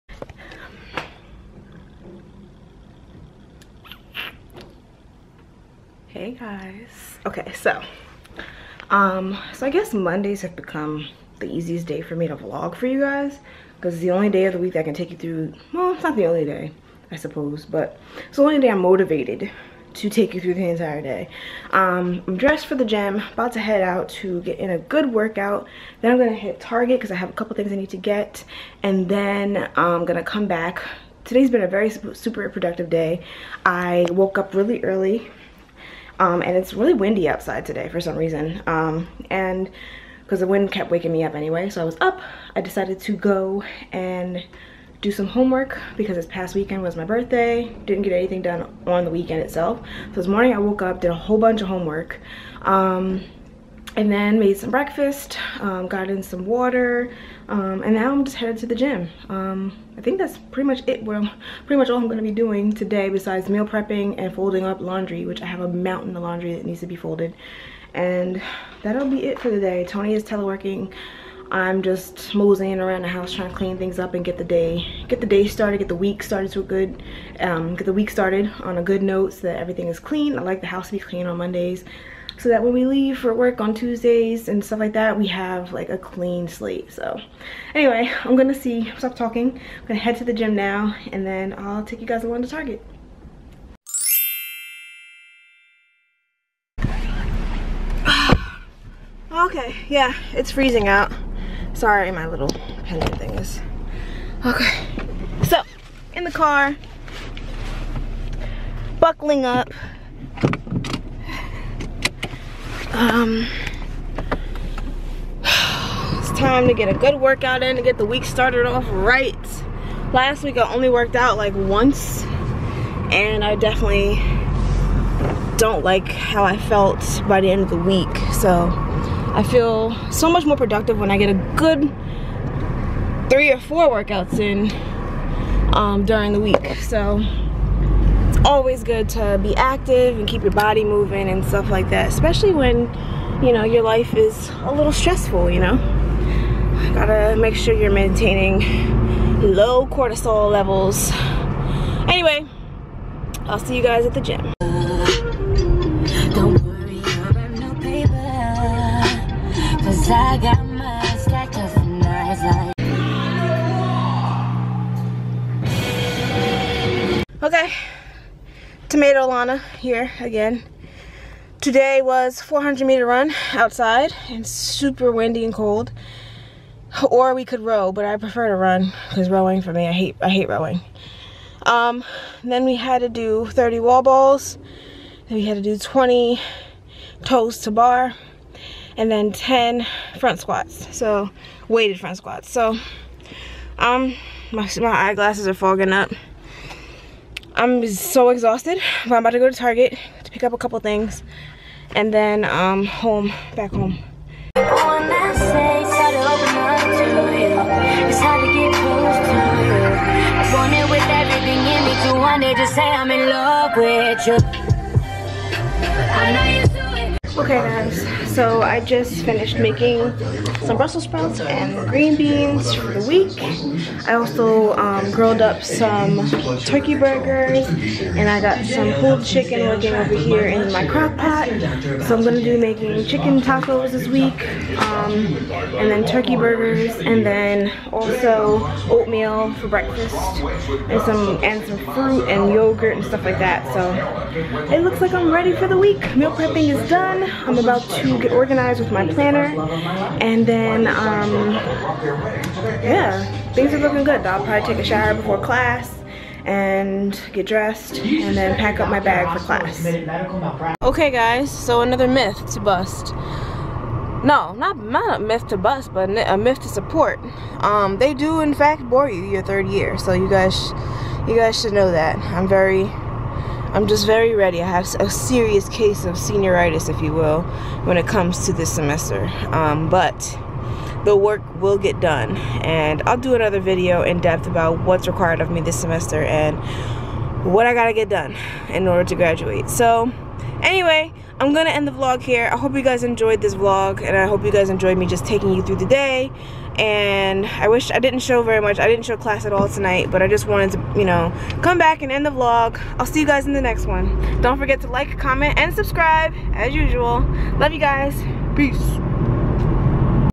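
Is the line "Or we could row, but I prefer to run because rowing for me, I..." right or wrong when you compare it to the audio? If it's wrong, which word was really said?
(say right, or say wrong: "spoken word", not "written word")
right.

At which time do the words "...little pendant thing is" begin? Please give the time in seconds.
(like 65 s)
102 s.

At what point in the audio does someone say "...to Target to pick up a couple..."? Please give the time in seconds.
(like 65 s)
199 s.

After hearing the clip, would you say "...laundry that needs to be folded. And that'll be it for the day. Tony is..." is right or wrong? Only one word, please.
right.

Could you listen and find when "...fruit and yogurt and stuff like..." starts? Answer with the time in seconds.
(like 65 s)
241 s.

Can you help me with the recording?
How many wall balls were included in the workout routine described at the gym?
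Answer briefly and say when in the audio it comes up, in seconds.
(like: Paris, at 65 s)
30, at 183 s.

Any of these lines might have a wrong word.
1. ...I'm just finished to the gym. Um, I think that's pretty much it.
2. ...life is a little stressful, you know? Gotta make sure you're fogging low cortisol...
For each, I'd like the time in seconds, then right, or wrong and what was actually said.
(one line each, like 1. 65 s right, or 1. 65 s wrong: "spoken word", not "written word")
1. 58 s wrong: "headed", not "finished"
2. 143 s wrong: "maintaining", not "fogging".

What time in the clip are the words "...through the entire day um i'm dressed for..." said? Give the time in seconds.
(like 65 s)
20 s.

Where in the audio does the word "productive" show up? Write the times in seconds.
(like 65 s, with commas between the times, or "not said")
32 s, 130 s.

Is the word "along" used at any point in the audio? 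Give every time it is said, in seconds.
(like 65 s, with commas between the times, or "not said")
92 s.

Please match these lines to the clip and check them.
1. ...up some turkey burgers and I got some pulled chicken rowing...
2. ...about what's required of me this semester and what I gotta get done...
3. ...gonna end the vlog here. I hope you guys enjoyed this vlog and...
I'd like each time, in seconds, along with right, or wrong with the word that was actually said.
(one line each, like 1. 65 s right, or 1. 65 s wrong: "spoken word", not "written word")
1. 225 s wrong: "working", not "rowing"
2. 284 s right
3. 291 s right.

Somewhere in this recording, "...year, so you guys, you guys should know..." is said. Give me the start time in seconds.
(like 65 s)
269 s.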